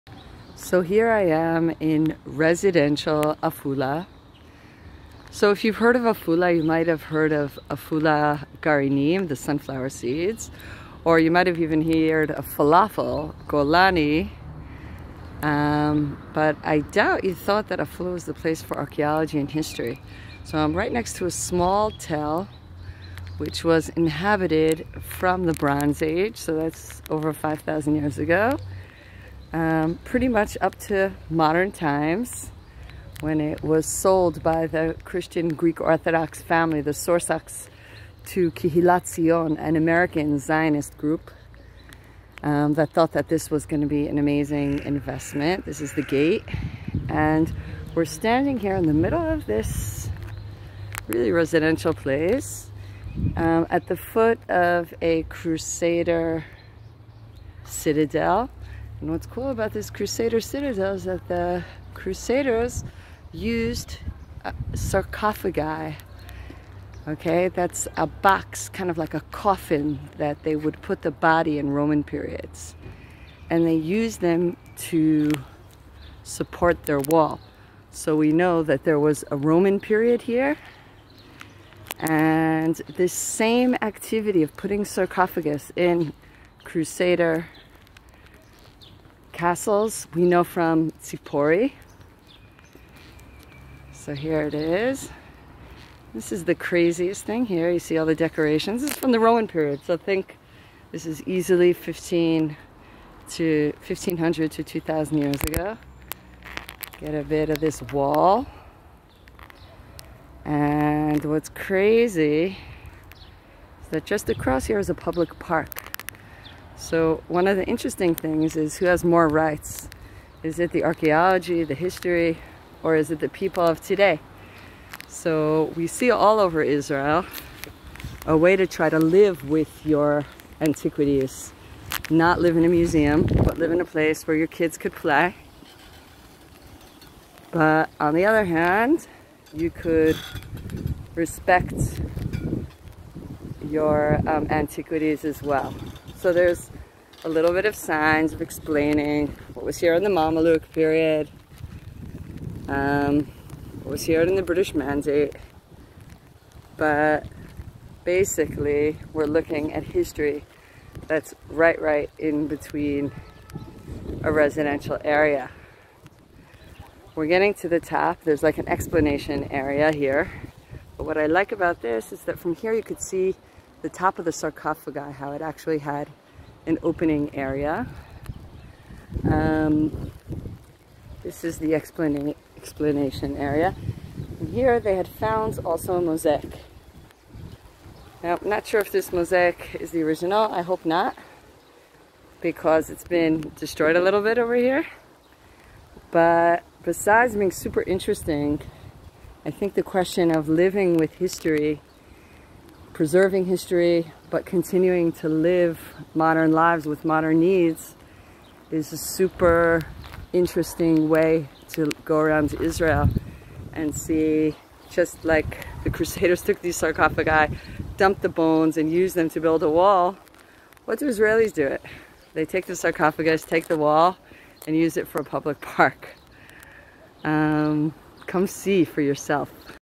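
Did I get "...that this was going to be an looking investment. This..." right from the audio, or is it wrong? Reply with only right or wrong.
wrong.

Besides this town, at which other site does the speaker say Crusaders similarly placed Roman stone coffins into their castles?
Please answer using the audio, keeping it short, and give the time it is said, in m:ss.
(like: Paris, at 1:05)
Tsipori, at 1:31.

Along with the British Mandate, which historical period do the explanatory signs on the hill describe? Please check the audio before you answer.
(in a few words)
Mameluke period.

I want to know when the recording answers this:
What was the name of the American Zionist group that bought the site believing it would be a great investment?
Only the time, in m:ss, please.
0:38.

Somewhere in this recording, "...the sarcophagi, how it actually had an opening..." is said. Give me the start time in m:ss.
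2:54.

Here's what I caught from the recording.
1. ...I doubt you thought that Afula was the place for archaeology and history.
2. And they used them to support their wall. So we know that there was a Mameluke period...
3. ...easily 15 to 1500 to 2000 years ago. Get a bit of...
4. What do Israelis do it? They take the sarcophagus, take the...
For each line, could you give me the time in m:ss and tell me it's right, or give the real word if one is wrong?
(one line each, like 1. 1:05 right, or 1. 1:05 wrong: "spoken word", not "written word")
1. 0:16 right
2. 1:13 wrong: "Roman", not "Mameluke"
3. 1:41 right
4. 3:40 right.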